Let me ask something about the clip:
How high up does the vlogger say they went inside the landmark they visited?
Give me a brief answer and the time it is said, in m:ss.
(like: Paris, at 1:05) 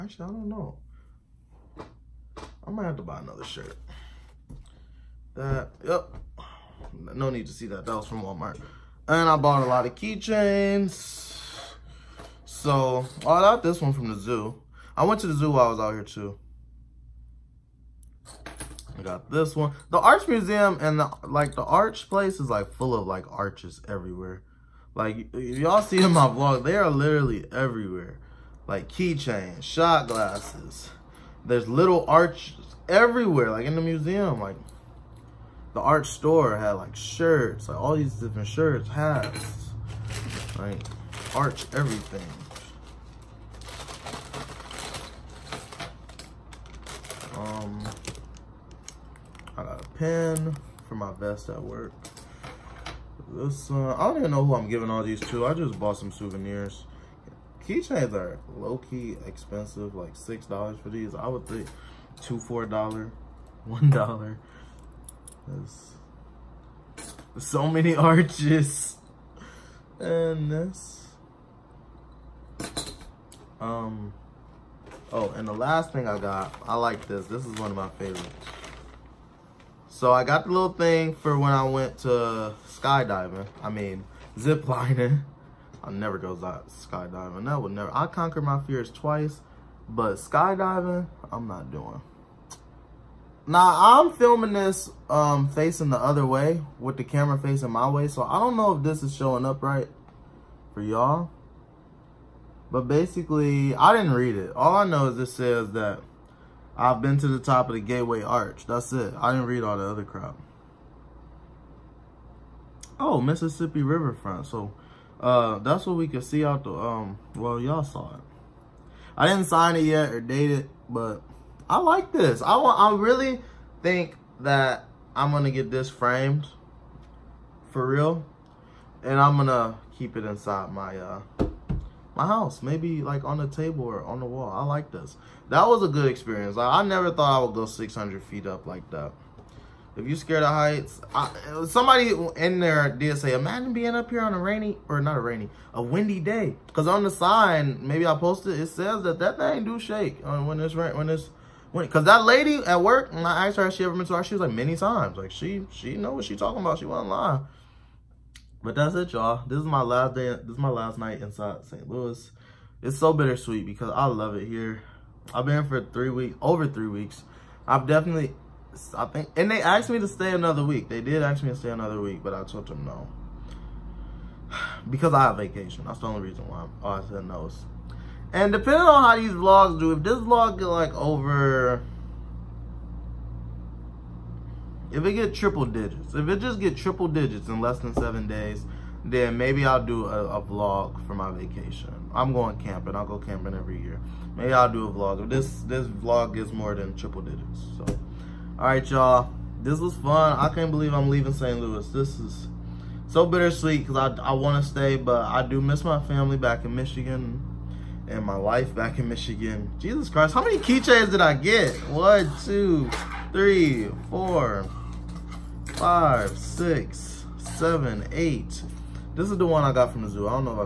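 600 feet, at 2:17.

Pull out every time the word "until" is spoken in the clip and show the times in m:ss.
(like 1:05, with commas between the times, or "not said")
not said.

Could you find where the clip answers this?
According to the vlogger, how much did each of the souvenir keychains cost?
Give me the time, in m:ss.
1:00.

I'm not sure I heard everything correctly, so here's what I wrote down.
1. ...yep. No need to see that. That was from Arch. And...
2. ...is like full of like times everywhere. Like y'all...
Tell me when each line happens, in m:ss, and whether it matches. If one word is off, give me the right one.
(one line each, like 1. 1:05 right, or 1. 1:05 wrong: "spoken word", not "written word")
1. 0:05 wrong: "Walmart", not "Arch"
2. 0:22 wrong: "arches", not "times".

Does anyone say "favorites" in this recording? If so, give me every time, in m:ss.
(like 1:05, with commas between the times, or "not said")
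1:17.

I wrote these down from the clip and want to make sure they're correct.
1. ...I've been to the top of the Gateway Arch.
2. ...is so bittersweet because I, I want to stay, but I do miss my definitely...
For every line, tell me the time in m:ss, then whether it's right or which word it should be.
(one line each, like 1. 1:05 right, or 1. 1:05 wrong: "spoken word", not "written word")
1. 1:46 right
2. 3:22 wrong: "family", not "definitely".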